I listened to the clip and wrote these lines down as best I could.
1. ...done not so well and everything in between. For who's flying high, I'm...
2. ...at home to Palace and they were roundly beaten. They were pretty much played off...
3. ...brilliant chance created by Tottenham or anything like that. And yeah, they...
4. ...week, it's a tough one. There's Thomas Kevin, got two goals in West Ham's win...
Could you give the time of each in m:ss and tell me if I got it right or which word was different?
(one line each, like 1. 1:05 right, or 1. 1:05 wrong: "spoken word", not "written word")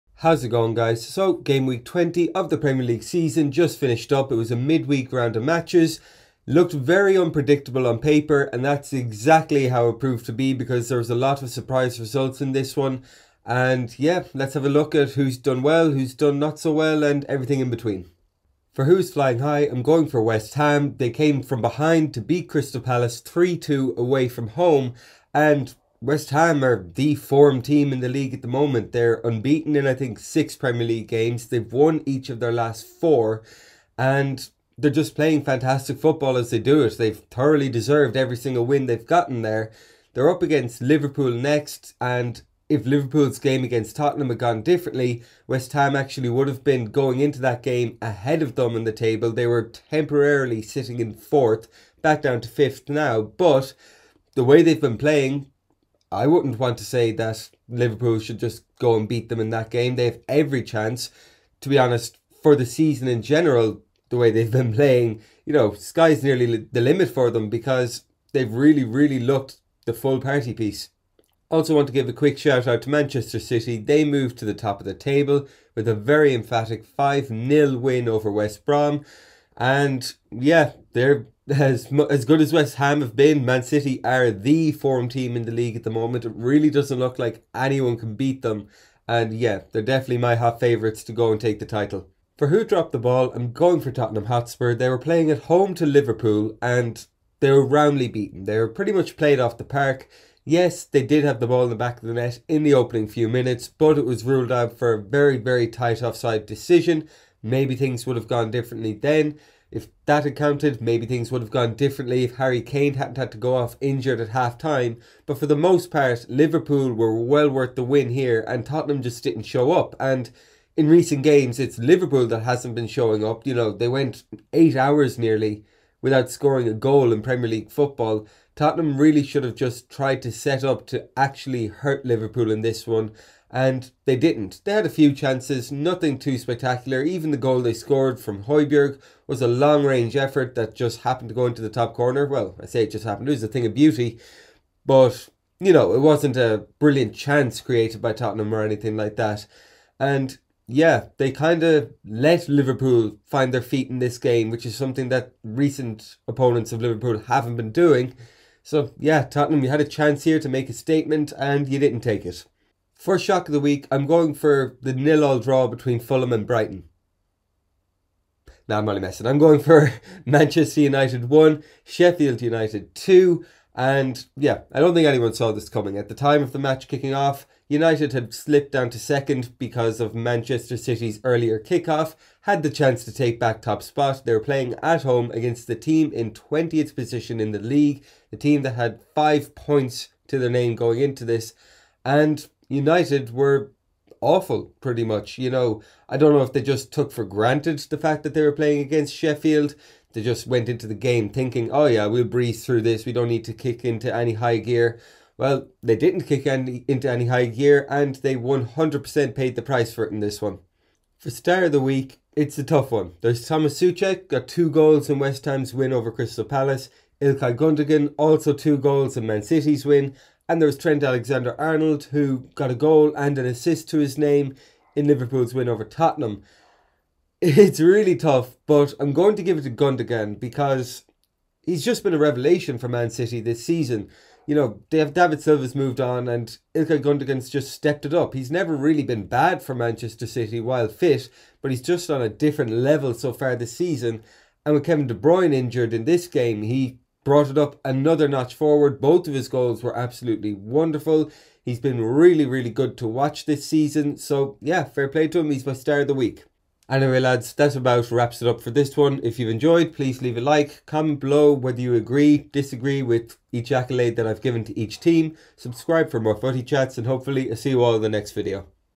1. 0:16 right
2. 1:35 wrong: "Liverpool", not "Palace"
3. 2:26 right
4. 3:31 wrong: "Soucek", not "Kevin".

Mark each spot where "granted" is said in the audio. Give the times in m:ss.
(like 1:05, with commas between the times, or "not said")
3:17.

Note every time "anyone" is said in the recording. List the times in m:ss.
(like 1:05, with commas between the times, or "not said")
1:27, 2:55.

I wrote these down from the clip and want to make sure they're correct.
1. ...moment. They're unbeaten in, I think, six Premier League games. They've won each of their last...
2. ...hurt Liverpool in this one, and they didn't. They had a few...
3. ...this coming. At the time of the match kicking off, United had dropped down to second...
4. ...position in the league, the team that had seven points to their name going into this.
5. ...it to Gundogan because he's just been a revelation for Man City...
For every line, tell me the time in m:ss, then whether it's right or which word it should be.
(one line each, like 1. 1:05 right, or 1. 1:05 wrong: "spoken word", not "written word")
1. 0:28 right
2. 2:11 right
3. 2:55 wrong: "slipped", not "dropped"
4. 3:06 wrong: "five", not "seven"
5. 3:49 right.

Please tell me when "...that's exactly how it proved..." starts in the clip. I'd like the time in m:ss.
0:08.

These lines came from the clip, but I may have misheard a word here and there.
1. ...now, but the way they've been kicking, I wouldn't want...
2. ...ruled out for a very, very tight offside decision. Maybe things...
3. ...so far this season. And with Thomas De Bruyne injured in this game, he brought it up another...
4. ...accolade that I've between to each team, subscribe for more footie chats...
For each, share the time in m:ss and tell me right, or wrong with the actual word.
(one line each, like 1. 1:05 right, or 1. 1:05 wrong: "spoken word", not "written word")
1. 0:52 wrong: "playing", not "kicking"
2. 1:44 right
3. 4:03 wrong: "Kevin", not "Thomas"
4. 4:23 wrong: "given", not "between".